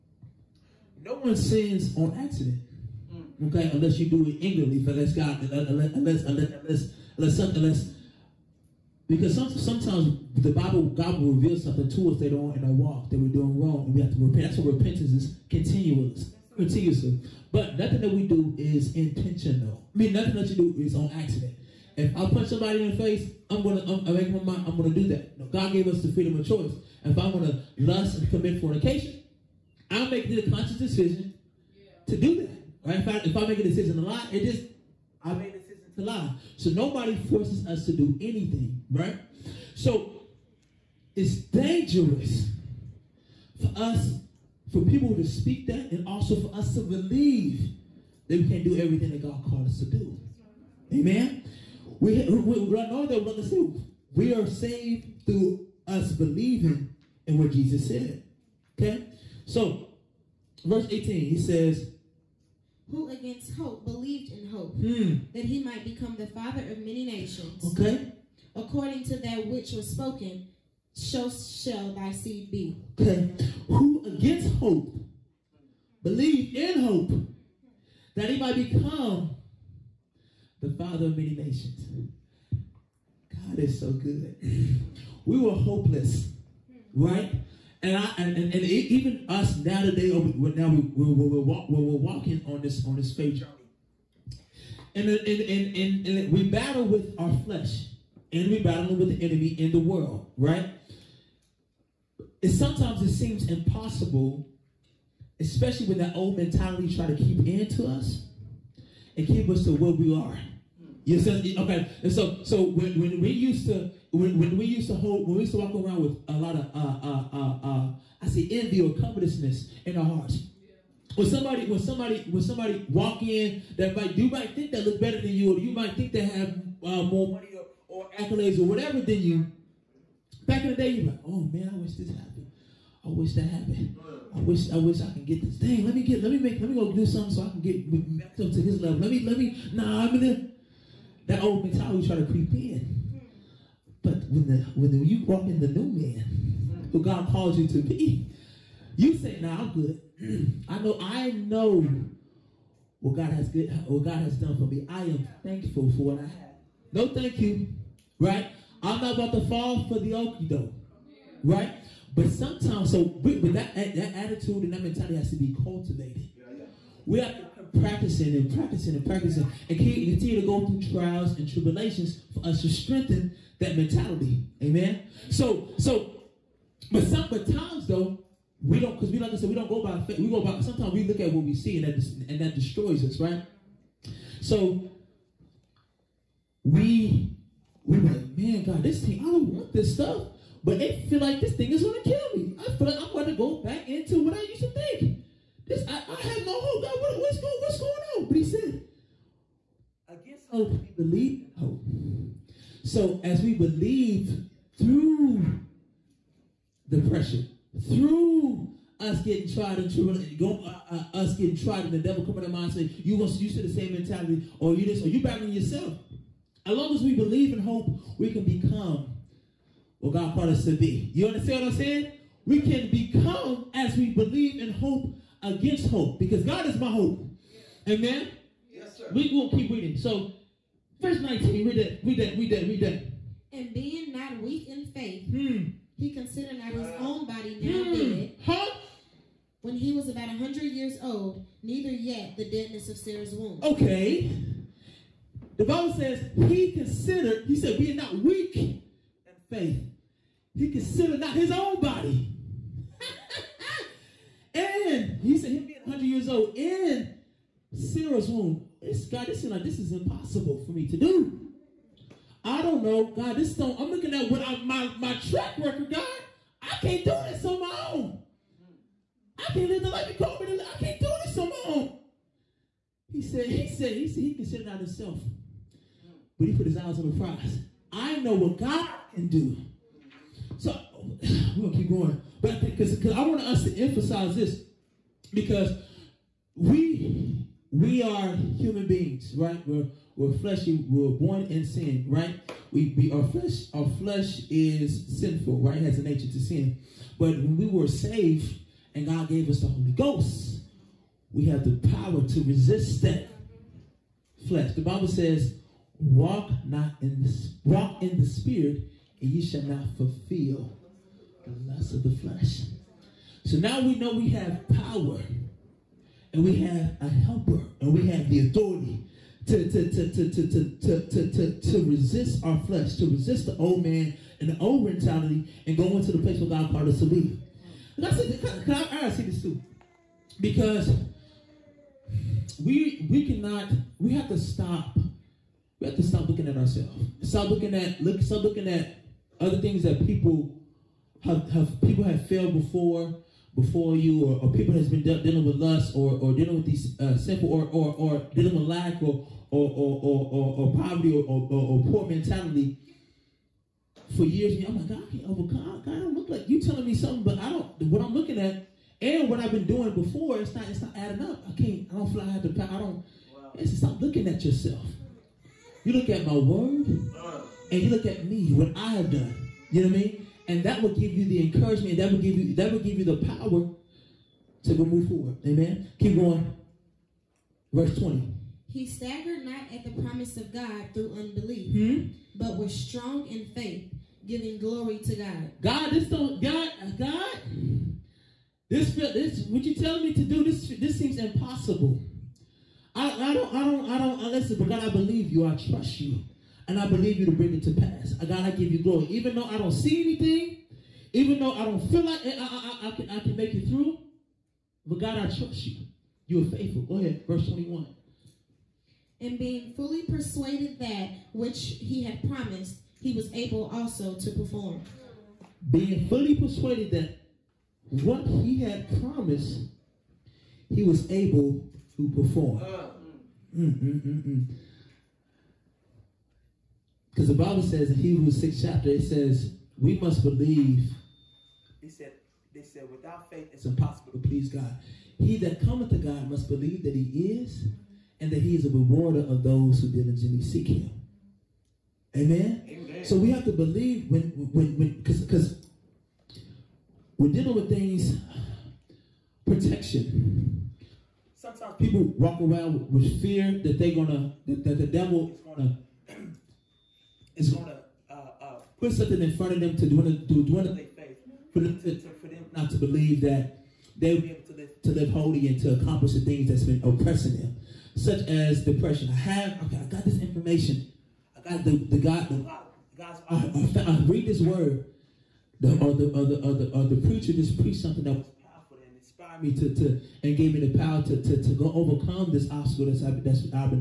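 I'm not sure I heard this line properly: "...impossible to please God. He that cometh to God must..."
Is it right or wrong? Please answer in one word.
right.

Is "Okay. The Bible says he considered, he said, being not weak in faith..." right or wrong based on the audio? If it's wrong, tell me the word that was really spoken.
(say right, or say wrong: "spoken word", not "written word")
right.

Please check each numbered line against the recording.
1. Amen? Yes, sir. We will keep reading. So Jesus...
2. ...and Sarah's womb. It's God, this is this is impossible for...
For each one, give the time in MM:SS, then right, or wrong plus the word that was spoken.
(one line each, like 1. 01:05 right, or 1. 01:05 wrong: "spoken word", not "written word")
1. 03:47 wrong: "Verse", not "Jesus"
2. 04:16 right.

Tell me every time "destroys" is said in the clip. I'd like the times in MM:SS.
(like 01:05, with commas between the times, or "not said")
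03:02.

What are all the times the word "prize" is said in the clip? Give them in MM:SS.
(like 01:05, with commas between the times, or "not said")
04:37.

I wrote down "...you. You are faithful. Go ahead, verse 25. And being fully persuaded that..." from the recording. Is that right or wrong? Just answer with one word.
wrong.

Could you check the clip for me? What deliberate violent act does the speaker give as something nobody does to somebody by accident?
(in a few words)
Punch somebody in the face.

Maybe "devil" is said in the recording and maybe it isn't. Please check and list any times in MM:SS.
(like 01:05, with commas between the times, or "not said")
03:31, 07:34.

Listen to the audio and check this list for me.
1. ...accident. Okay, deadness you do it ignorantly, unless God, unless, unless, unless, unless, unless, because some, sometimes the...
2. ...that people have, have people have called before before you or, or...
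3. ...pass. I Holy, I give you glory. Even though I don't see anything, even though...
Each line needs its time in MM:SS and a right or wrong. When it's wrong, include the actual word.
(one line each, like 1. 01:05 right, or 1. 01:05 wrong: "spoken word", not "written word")
1. 00:02 wrong: "unless", not "deadness"
2. 05:39 wrong: "failed", not "called"
3. 06:37 wrong: "God", not "Holy".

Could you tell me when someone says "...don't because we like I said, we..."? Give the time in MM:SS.
02:58.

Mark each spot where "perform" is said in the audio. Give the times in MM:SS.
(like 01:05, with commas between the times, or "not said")
06:54, 07:02.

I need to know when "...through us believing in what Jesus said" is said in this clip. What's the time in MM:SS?
00:55.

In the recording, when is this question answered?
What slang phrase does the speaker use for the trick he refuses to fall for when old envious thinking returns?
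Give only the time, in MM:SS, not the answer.
02:40.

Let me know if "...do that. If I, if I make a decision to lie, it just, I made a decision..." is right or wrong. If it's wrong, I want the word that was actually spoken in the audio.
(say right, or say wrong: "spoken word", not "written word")
right.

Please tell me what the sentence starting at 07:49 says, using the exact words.
I have, okay, I got this information.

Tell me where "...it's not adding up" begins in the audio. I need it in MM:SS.
06:00.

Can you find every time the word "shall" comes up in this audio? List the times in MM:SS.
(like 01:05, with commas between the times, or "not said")
01:11, 05:09.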